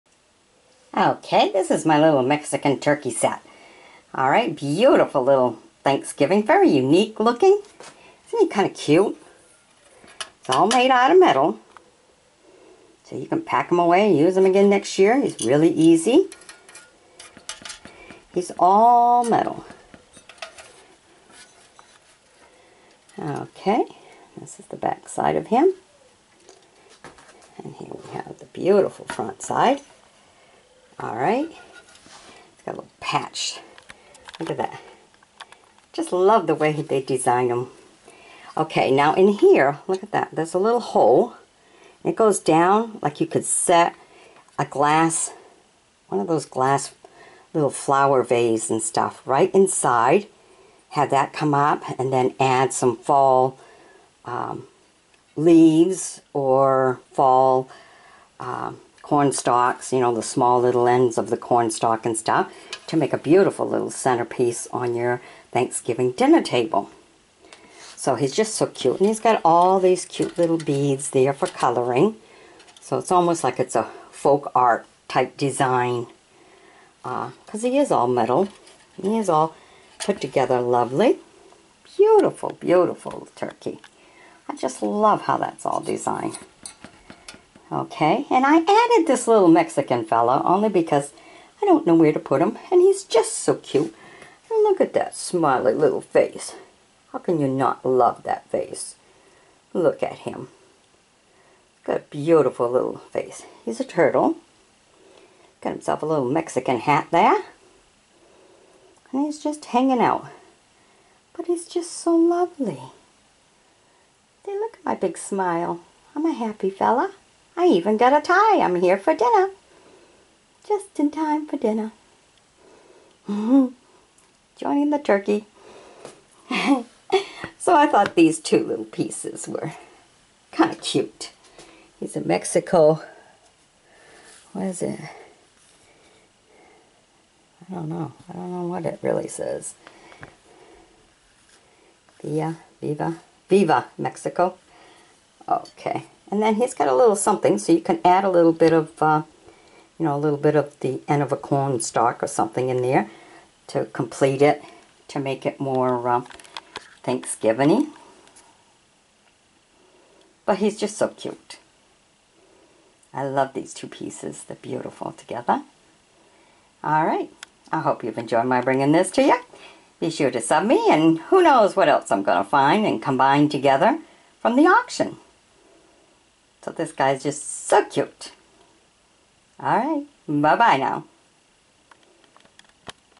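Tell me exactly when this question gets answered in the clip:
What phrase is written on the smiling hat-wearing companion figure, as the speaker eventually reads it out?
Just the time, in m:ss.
2:23.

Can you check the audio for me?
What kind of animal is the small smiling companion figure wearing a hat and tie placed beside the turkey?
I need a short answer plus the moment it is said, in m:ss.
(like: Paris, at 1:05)
turtle, at 1:43.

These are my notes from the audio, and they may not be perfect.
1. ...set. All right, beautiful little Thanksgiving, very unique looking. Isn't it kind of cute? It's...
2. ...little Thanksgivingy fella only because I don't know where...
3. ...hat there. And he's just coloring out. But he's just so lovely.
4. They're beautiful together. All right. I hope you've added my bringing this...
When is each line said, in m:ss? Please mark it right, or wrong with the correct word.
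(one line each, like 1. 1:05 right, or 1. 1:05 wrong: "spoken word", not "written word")
1. 0:03 right
2. 1:29 wrong: "Mexican", not "Thanksgivingy"
3. 1:46 wrong: "hanging", not "coloring"
4. 2:44 wrong: "enjoyed", not "added".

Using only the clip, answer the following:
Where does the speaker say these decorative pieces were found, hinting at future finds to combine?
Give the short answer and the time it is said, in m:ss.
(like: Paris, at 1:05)
the auction, at 2:54.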